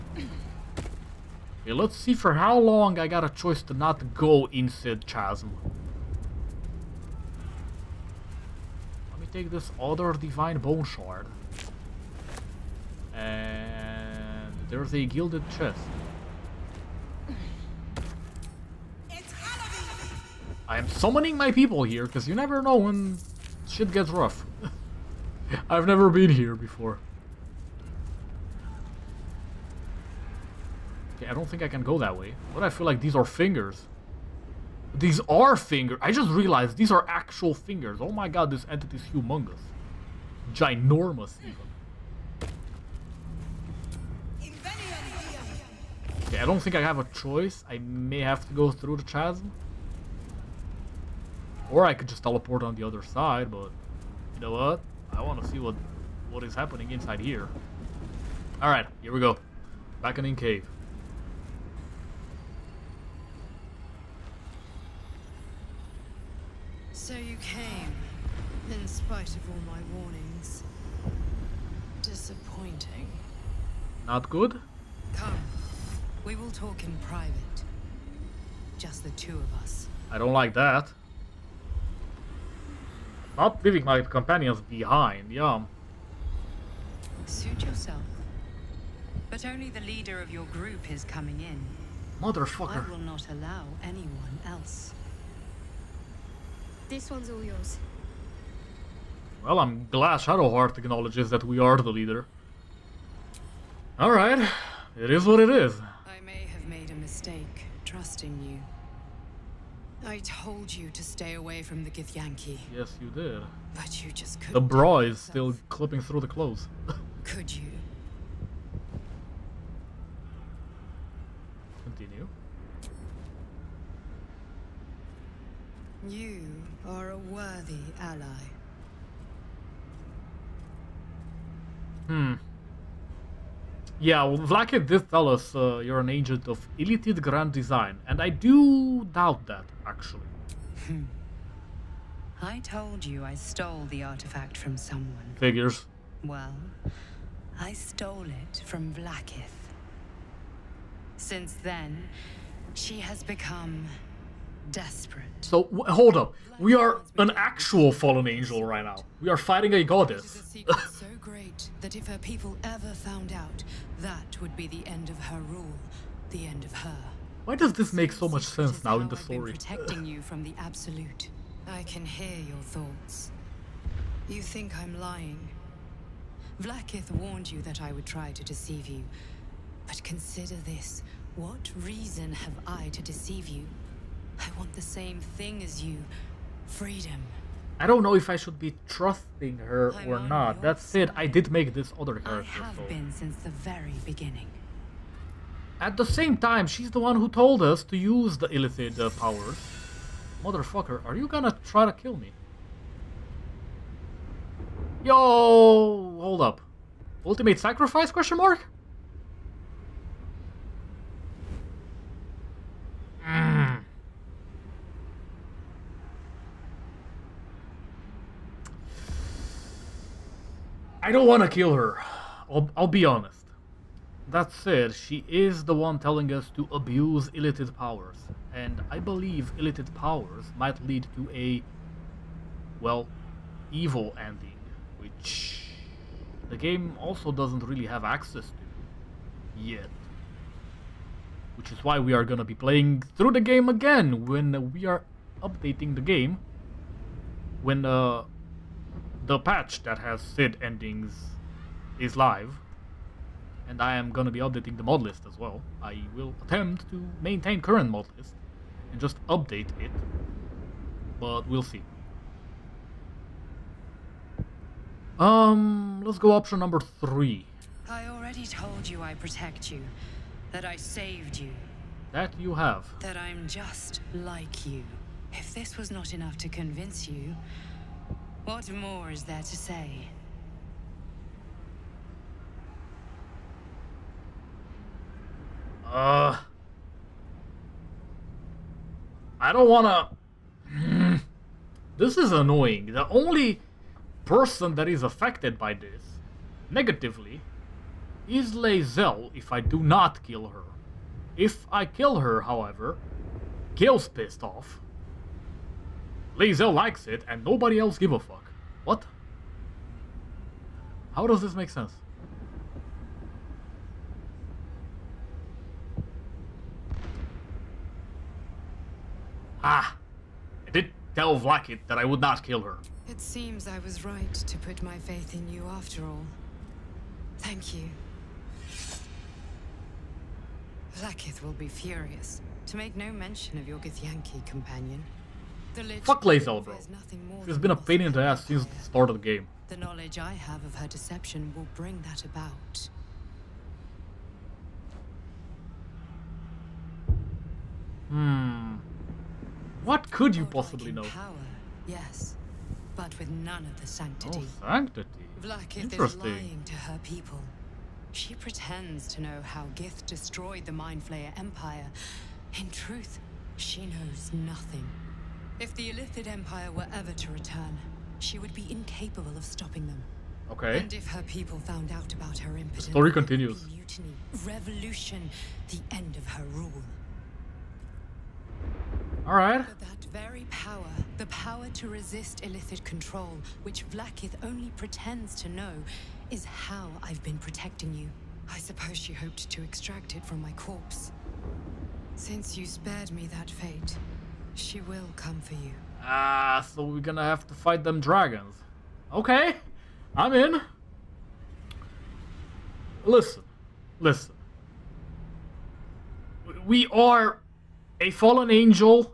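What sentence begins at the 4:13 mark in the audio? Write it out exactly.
And I am going to be updating the mod list as well.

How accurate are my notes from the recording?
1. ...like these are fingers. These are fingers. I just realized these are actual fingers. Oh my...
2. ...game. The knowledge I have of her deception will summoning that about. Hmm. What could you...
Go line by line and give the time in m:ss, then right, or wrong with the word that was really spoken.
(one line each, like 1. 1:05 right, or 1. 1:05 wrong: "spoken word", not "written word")
1. 0:32 right
2. 5:39 wrong: "bring", not "summoning".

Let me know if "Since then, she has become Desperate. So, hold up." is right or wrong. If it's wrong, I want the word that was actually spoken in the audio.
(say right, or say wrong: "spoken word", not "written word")
right.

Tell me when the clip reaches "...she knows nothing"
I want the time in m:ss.
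6:03.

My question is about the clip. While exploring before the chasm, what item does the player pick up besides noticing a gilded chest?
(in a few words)
Divine bone shard.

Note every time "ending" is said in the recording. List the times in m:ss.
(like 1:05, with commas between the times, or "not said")
3:54, 4:10.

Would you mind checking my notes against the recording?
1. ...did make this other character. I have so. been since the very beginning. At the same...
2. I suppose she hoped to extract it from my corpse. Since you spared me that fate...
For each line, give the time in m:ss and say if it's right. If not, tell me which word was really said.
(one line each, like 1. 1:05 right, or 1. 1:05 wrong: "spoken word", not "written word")
1. 3:11 right
2. 6:28 right.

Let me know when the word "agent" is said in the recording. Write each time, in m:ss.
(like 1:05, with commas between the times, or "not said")
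2:16.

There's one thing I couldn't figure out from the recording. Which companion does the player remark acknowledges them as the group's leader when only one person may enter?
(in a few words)
Shadowheart.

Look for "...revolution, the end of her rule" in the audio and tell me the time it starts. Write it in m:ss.
6:14.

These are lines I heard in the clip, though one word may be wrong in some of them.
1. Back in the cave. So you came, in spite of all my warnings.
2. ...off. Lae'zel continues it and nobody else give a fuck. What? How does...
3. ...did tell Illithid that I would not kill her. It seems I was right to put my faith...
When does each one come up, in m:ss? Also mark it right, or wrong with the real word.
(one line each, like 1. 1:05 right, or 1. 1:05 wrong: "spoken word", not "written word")
1. 1:00 right
2. 5:04 wrong: "likes", not "continues"
3. 5:20 wrong: "Vlaakith", not "Illithid".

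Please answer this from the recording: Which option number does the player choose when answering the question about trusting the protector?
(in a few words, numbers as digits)
3.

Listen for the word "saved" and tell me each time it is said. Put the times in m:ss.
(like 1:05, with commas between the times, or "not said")
4:30.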